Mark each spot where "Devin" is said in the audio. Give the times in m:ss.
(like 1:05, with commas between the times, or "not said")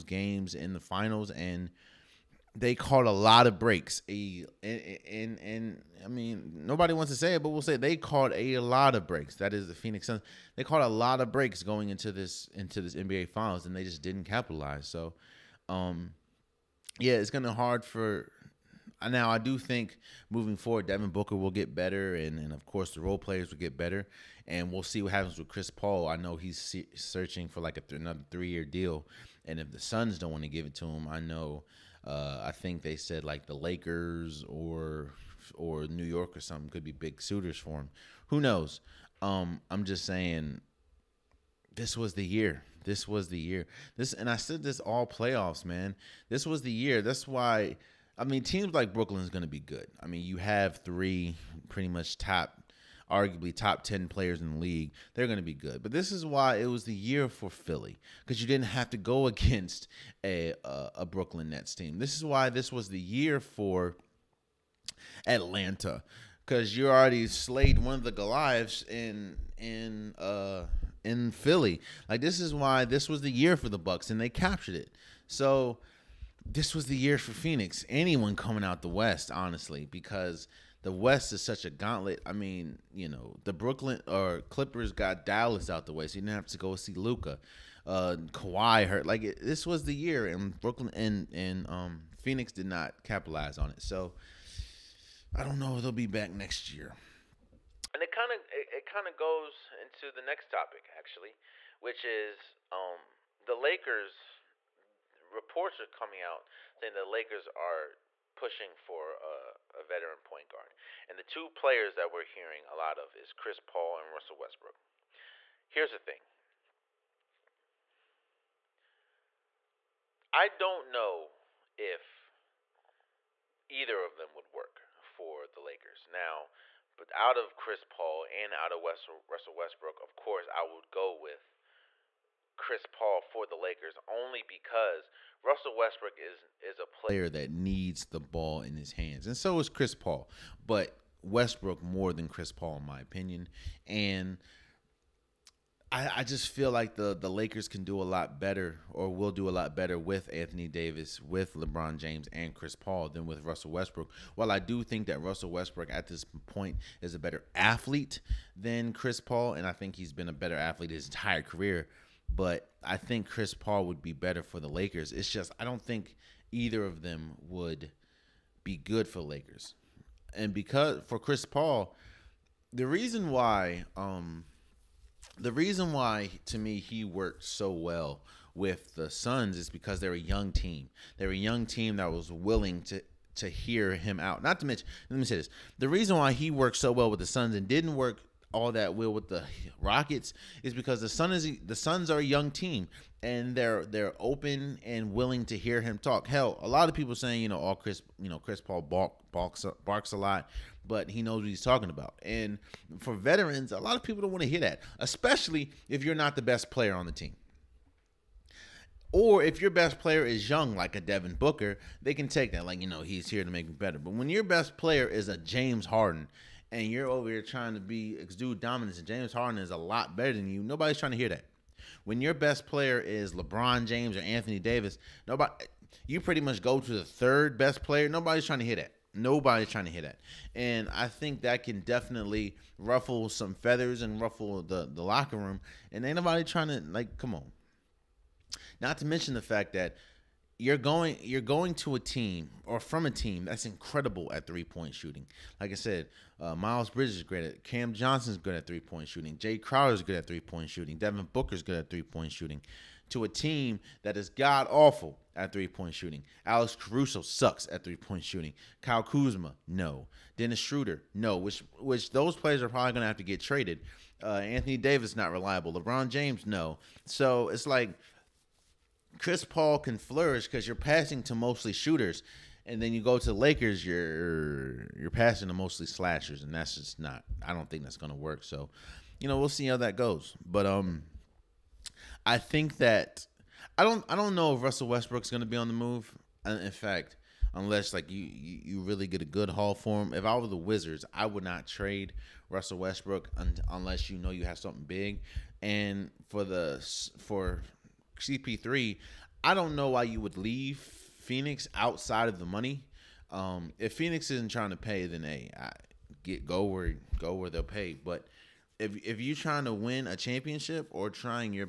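0:20, 3:31, 4:10.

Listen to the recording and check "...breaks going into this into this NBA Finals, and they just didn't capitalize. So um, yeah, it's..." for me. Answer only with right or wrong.
right.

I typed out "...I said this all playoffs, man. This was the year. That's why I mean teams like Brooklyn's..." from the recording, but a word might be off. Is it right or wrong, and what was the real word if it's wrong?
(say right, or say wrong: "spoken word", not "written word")
right.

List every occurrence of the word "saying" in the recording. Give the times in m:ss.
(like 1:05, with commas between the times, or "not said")
0:40, 1:46, 3:17.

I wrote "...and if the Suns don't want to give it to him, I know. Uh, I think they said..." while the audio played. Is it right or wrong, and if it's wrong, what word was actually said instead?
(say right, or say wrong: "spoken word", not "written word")
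right.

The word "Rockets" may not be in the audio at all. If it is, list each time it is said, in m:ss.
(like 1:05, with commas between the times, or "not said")
3:09.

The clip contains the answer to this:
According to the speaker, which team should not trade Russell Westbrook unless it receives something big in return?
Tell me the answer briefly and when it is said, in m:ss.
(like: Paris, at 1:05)
The Wizards, at 4:50.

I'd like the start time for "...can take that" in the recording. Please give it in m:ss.
3:32.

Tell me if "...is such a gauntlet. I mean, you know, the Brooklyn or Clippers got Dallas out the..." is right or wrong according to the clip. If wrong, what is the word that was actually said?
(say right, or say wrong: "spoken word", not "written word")
right.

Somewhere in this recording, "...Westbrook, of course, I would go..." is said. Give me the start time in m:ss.
2:09.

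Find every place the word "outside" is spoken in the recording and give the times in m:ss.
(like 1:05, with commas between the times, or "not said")
5:01.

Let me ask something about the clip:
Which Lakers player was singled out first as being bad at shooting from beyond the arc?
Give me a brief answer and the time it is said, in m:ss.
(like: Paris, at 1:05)
Alex Caruso, at 4:16.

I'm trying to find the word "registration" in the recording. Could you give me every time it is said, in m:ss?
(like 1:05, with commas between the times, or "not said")
not said.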